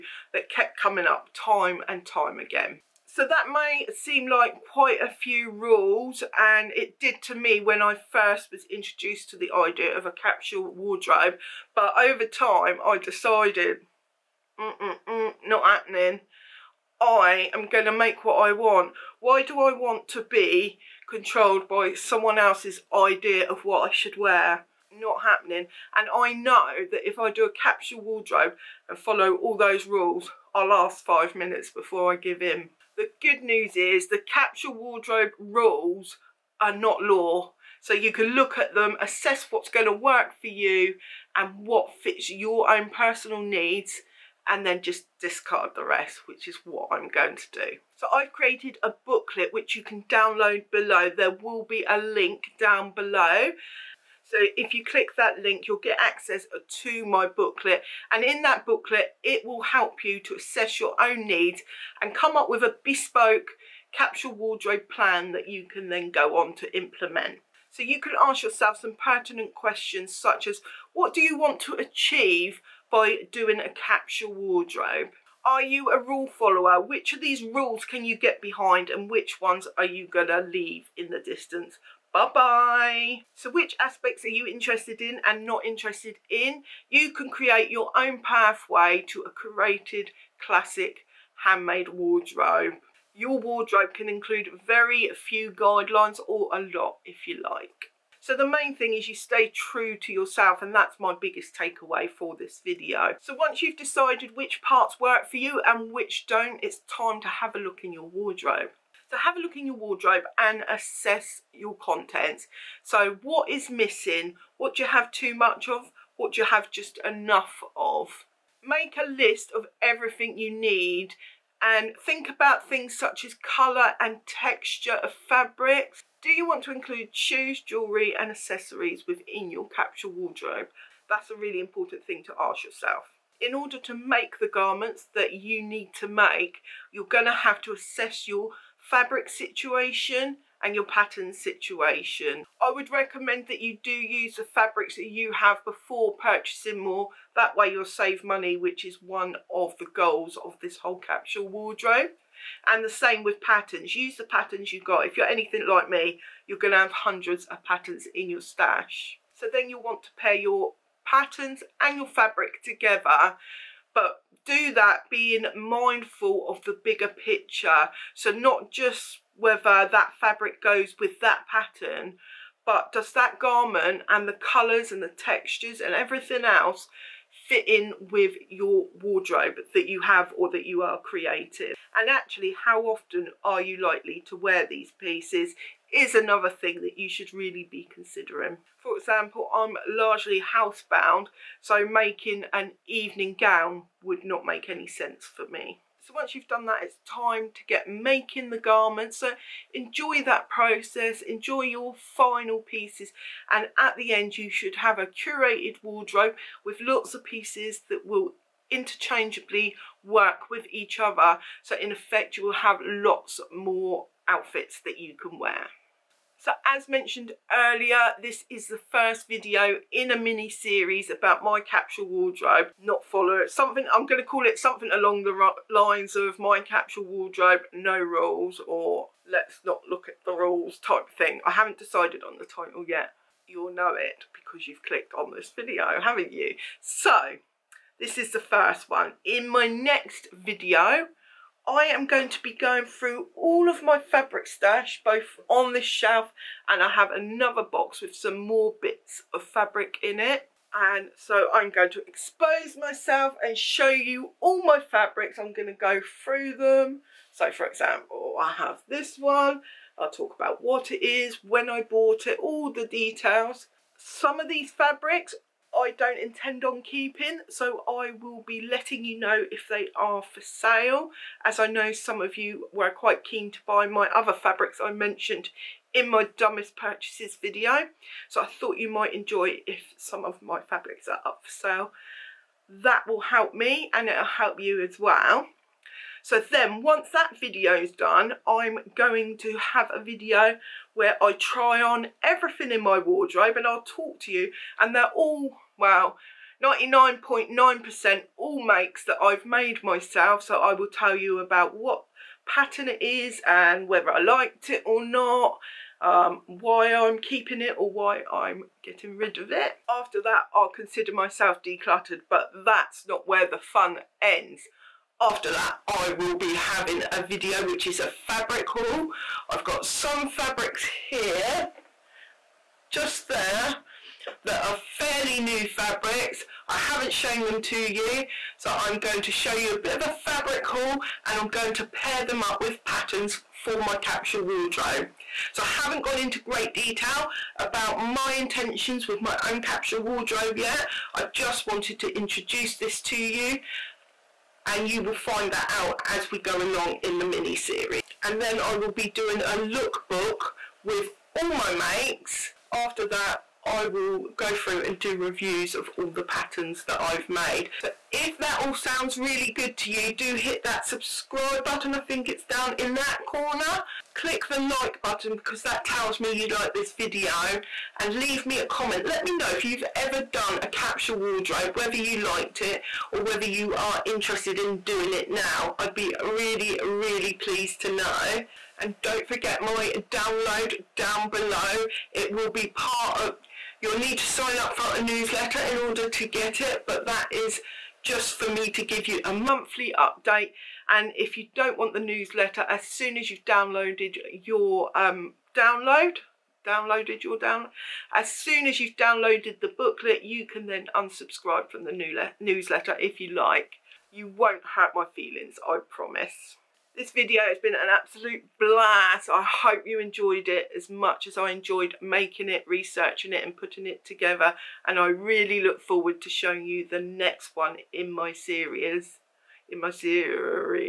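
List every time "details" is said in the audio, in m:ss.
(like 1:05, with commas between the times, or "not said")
4:22, 5:36.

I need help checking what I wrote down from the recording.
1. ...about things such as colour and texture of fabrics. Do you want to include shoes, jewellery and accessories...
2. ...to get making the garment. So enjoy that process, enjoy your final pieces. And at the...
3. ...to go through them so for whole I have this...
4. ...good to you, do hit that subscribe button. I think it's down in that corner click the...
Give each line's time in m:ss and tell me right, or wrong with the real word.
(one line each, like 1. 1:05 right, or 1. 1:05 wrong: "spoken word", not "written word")
1. 2:02 right
2. 3:17 right
3. 4:15 wrong: "example", not "whole"
4. 5:59 right.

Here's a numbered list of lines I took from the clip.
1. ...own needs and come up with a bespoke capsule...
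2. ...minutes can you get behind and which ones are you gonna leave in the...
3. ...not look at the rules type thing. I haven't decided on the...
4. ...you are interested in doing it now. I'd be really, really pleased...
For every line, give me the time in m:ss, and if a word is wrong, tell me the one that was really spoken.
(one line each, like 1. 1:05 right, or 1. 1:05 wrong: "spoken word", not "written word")
1. 1:01 right
2. 1:17 wrong: "rules", not "minutes"
3. 3:49 right
4. 6:13 right.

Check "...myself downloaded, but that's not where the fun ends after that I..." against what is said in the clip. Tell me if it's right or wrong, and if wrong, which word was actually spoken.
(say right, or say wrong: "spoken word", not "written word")
wrong: "decluttered", not "downloaded".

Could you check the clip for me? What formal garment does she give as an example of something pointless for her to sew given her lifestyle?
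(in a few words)
An evening gown.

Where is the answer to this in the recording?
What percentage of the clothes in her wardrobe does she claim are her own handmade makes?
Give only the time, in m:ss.
4:56.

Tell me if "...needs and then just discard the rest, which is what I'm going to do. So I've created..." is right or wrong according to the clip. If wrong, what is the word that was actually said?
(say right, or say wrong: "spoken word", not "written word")
right.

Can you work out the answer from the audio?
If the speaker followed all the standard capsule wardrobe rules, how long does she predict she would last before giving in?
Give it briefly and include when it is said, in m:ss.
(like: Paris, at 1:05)
5 minutes, at 0:31.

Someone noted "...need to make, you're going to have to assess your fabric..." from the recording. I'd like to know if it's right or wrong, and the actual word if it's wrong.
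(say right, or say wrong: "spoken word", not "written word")
right.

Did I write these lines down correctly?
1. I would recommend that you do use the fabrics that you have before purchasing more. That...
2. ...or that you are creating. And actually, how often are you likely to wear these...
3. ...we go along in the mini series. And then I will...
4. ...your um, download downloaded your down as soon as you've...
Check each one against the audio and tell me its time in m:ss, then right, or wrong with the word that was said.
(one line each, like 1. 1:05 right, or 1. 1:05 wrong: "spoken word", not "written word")
1. 2:22 right
2. 3:00 right
3. 5:46 right
4. 6:34 right.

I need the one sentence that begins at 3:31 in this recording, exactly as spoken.
So in effect, you will have lots more outfits that you can wear.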